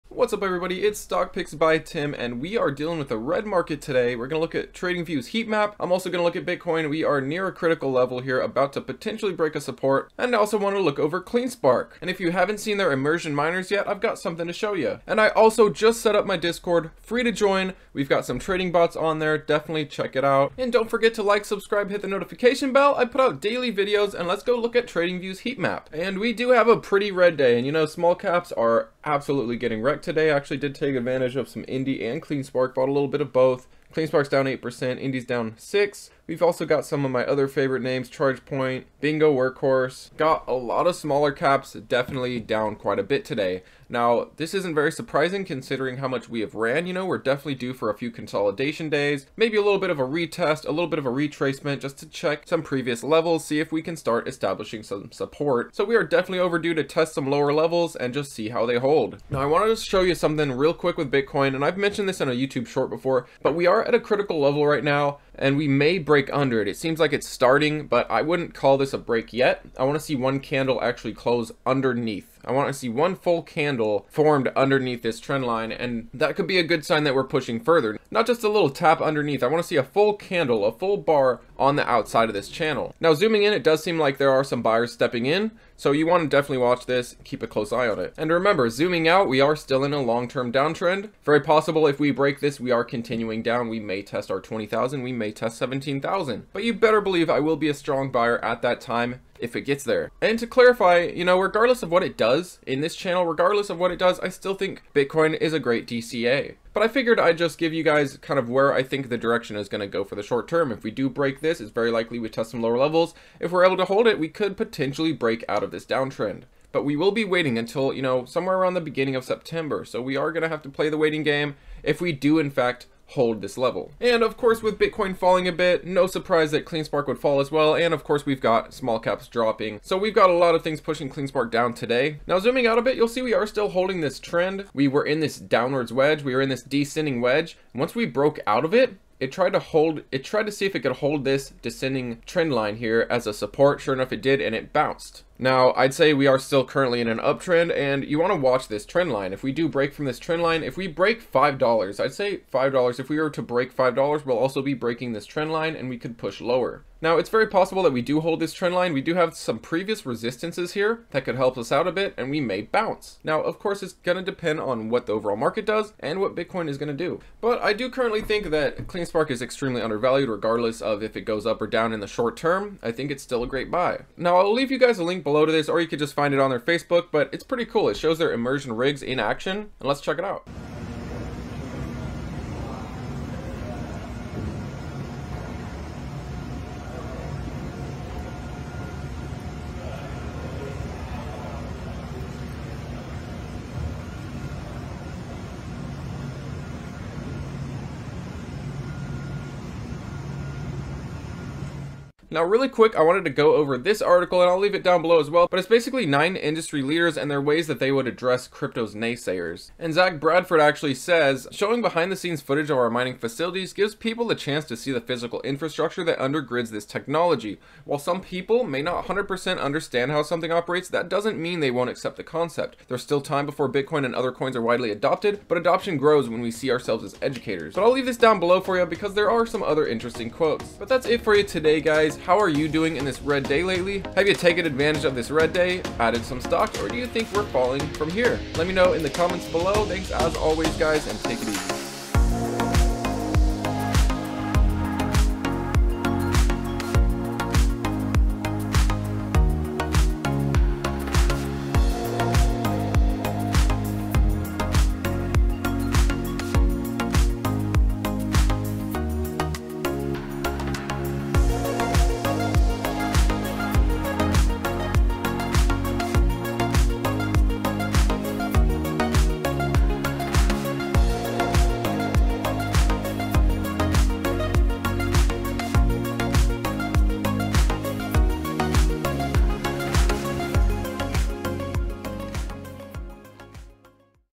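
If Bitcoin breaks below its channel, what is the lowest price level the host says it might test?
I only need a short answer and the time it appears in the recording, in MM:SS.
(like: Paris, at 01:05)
17,000, at 01:35.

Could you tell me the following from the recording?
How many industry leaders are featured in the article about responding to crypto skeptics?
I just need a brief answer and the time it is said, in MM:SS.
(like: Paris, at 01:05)
9, at 03:26.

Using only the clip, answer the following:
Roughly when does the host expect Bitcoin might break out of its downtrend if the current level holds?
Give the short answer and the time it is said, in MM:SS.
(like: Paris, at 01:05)
beginning of September, at 01:58.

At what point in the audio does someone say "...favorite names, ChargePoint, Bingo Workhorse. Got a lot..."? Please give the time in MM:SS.
00:37.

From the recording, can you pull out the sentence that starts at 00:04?
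We're going to look at TradingView's heat map.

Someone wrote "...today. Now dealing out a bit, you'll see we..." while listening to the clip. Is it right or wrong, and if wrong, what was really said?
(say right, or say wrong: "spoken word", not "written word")
wrong: "zooming", not "dealing".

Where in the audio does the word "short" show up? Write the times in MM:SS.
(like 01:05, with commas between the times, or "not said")
01:02, 01:50, 02:52.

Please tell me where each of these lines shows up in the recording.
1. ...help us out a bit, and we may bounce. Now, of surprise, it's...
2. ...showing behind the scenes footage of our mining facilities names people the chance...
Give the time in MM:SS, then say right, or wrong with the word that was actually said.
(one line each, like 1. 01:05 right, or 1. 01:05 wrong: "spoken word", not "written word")
1. 02:41 wrong: "course", not "surprise"
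2. 03:31 wrong: "gives", not "names".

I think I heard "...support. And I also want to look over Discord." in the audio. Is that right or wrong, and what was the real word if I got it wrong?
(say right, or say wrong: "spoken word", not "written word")
wrong: "CleanSpark", not "Discord".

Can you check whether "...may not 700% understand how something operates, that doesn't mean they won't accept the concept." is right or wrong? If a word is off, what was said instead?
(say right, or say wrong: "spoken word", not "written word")
wrong: "100", not "700".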